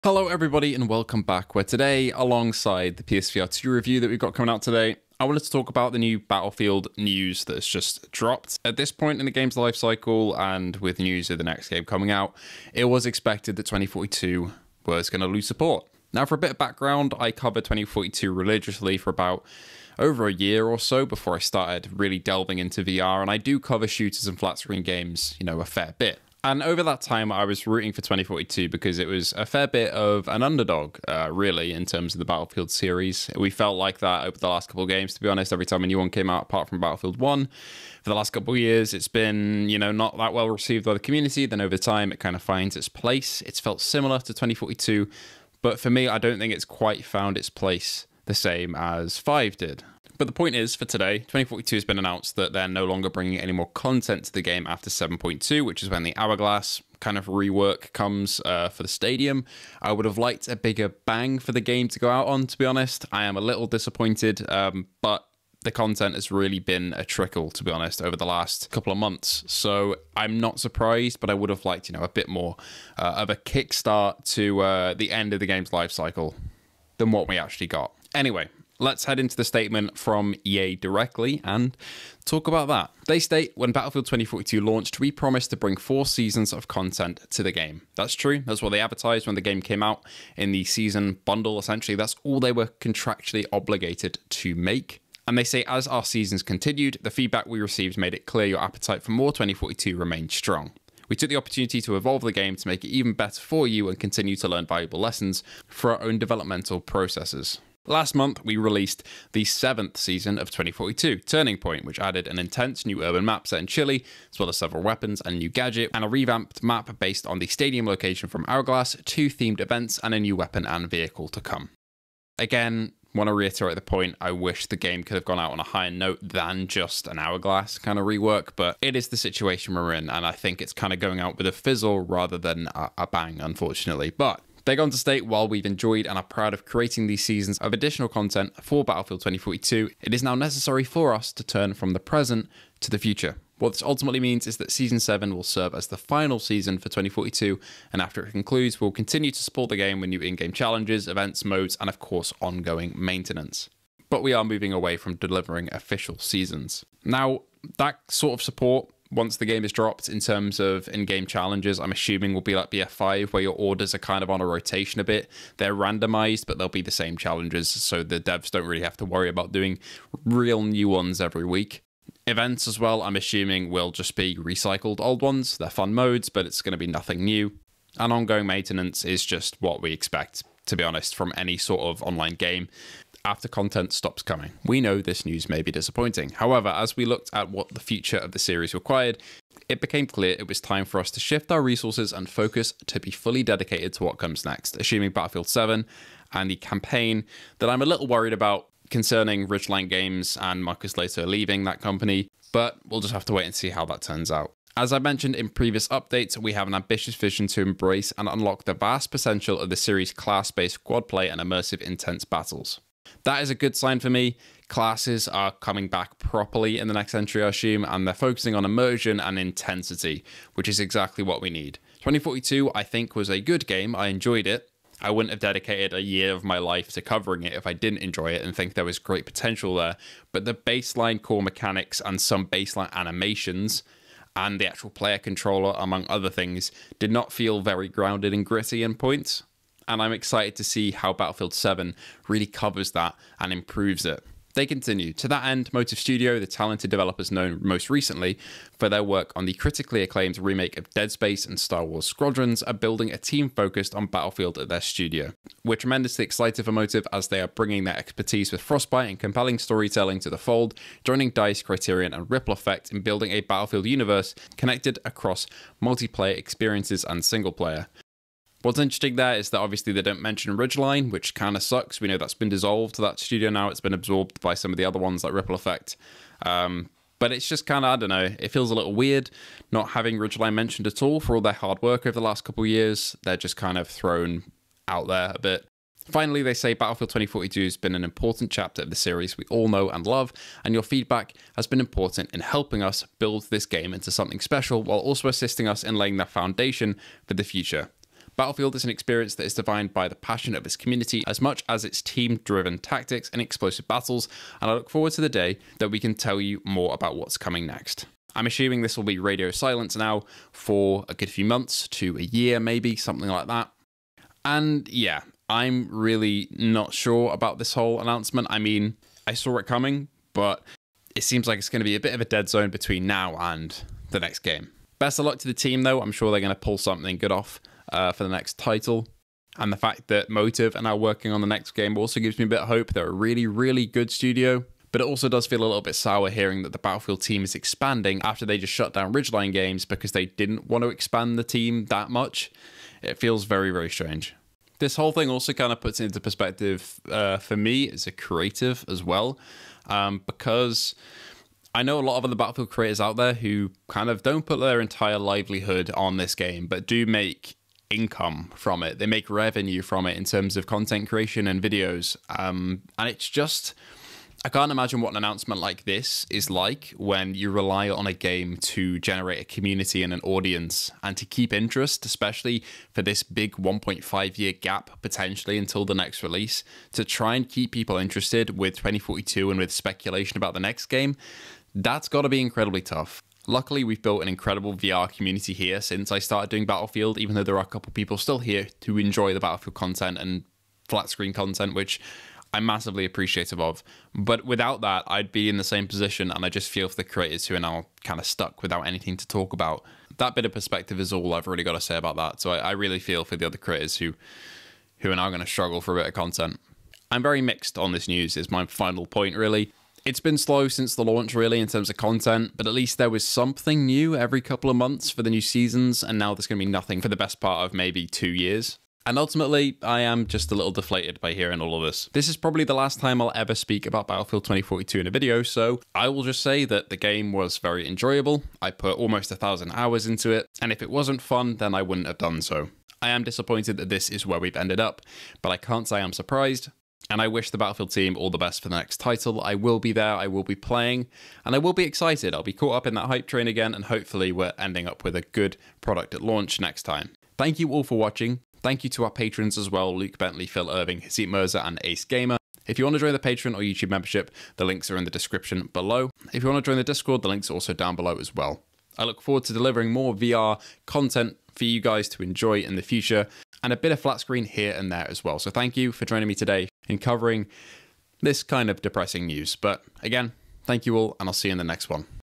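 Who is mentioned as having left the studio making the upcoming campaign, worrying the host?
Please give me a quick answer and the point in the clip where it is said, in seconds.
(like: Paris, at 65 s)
Marcus Lehto, at 200 s.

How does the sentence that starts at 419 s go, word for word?
And ultimately, I am just a little deflated by hearing all of this.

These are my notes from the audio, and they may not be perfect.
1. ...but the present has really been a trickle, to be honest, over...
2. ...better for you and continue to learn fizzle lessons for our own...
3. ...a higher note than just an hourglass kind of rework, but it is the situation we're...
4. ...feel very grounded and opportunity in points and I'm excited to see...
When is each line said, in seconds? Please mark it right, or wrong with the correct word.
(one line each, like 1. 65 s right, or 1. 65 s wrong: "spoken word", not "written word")
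1. 65 s wrong: "content", not "present"
2. 103 s wrong: "valuable", not "fizzle"
3. 125 s right
4. 237 s wrong: "gritty", not "opportunity".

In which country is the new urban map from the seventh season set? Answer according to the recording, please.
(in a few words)
Chile.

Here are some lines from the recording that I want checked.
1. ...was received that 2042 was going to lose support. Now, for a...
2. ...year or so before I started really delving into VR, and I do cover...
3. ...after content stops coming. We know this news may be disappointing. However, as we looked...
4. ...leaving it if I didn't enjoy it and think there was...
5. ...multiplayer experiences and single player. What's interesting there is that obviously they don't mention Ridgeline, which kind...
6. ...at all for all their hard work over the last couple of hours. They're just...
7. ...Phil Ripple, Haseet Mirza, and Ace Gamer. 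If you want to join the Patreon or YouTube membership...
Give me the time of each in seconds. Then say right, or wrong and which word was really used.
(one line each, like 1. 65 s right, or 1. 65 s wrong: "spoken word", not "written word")
1. 12 s wrong: "expected", not "received"
2. 20 s right
3. 183 s right
4. 227 s wrong: "covering", not "leaving"
5. 265 s right
6. 280 s wrong: "years", not "hours"
7. 450 s wrong: "Irving", not "Ripple".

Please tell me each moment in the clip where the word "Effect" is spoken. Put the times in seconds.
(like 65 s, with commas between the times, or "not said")
262 s, 275 s.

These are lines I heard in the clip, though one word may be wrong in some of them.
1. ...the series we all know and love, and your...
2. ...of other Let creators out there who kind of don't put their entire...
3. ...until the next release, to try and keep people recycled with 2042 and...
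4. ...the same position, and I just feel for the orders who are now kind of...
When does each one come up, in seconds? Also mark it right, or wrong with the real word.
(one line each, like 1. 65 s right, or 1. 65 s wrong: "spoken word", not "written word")
1. 288 s right
2. 352 s wrong: "Battlefield", not "Let"
3. 375 s wrong: "interested", not "recycled"
4. 395 s wrong: "creators", not "orders".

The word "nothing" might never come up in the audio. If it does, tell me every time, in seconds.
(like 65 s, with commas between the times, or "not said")
176 s, 416 s.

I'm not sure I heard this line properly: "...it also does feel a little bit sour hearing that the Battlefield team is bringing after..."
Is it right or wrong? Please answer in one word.
wrong.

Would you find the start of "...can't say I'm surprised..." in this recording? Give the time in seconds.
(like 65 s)
435 s.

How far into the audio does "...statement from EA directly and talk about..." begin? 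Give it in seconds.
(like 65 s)
79 s.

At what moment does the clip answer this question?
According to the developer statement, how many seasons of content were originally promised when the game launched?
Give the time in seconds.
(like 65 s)
85 s.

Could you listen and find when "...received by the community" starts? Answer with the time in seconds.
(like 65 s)
40 s.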